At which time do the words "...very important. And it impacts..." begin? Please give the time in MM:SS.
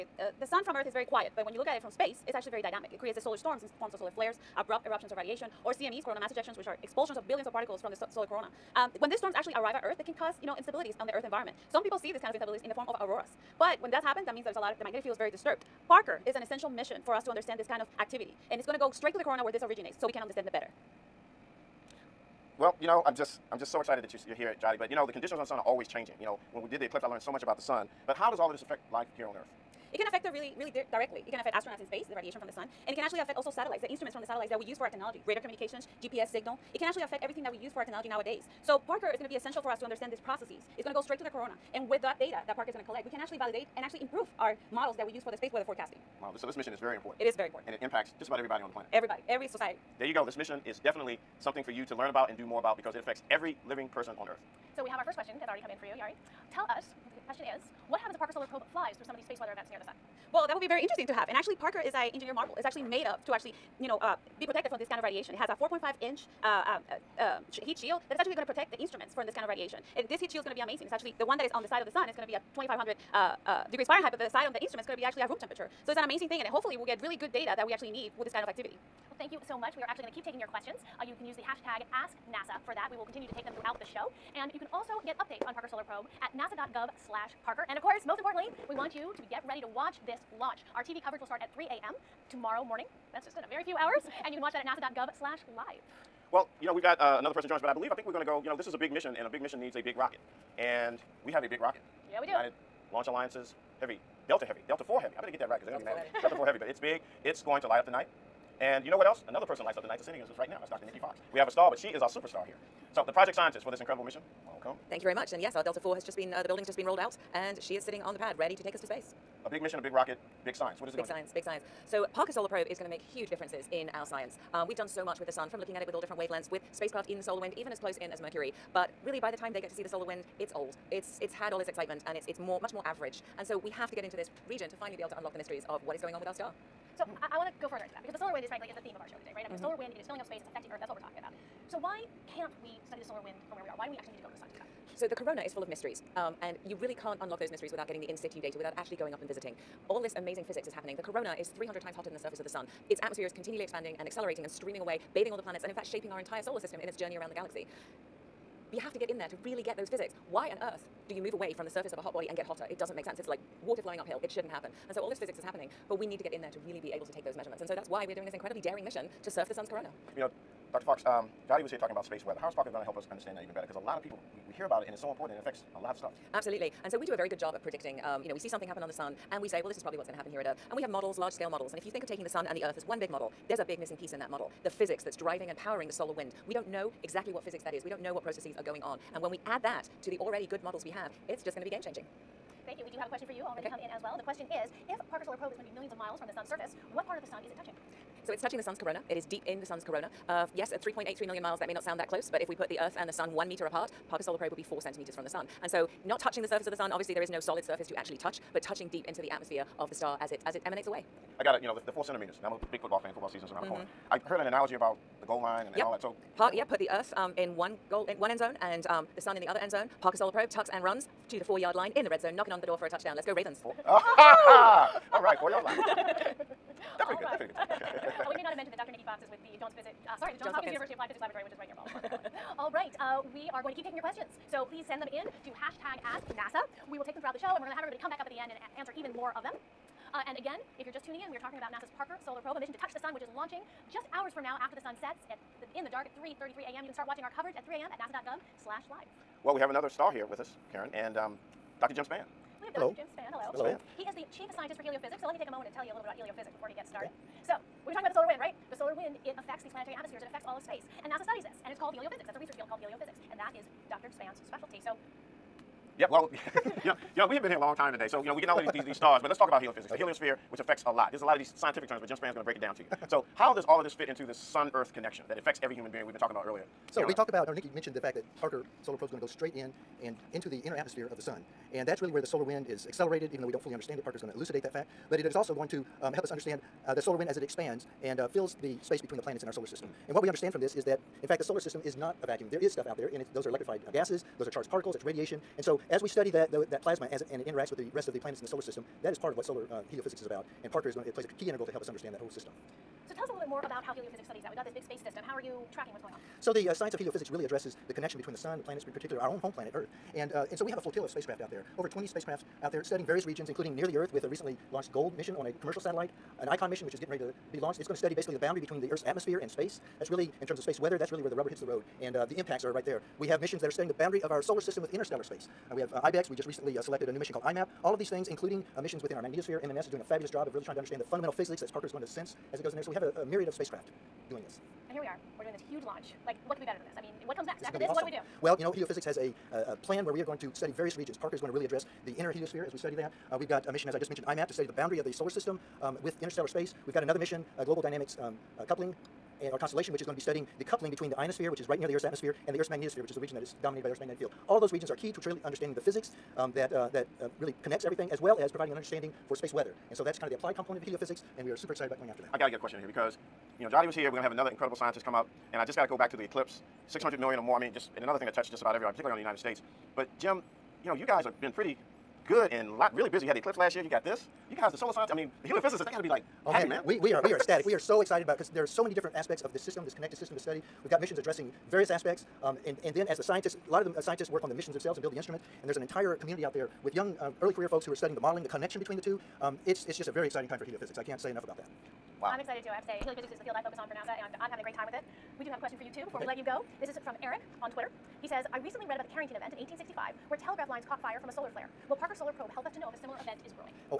00:47.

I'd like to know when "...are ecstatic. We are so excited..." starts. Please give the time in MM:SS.
06:17.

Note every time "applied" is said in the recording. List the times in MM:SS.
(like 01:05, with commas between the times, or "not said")
03:50, 06:00.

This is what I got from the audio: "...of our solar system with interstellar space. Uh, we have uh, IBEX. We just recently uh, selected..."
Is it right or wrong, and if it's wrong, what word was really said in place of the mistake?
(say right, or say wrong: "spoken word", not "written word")
right.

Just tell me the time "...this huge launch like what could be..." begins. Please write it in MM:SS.
05:35.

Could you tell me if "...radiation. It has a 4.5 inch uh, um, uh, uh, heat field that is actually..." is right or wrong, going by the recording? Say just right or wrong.
wrong.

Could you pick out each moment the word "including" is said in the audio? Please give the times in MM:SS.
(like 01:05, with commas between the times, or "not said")
05:13, 05:28.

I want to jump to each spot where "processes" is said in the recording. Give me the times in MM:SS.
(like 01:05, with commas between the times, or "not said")
00:40, 03:08.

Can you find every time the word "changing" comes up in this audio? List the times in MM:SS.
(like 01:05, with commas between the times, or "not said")
00:25, 03:11.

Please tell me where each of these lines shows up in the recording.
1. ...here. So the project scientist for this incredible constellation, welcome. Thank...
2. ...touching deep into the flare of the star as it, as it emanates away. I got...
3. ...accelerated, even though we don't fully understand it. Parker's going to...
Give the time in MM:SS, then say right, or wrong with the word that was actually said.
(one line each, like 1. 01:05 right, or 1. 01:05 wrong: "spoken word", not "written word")
1. 01:52 wrong: "mission", not "constellation"
2. 03:28 wrong: "atmosphere", not "flare"
3. 04:42 right.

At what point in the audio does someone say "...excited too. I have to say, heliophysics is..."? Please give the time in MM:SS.
06:32.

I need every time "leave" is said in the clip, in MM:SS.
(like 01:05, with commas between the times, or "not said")
not said.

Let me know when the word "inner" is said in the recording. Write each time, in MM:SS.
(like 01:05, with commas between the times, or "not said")
04:40, 05:42.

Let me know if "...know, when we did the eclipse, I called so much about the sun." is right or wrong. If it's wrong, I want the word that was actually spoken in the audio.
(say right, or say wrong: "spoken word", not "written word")
wrong: "learned", not "called".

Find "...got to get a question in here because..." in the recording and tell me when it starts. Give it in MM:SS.
06:02.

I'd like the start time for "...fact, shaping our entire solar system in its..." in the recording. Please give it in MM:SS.
02:35.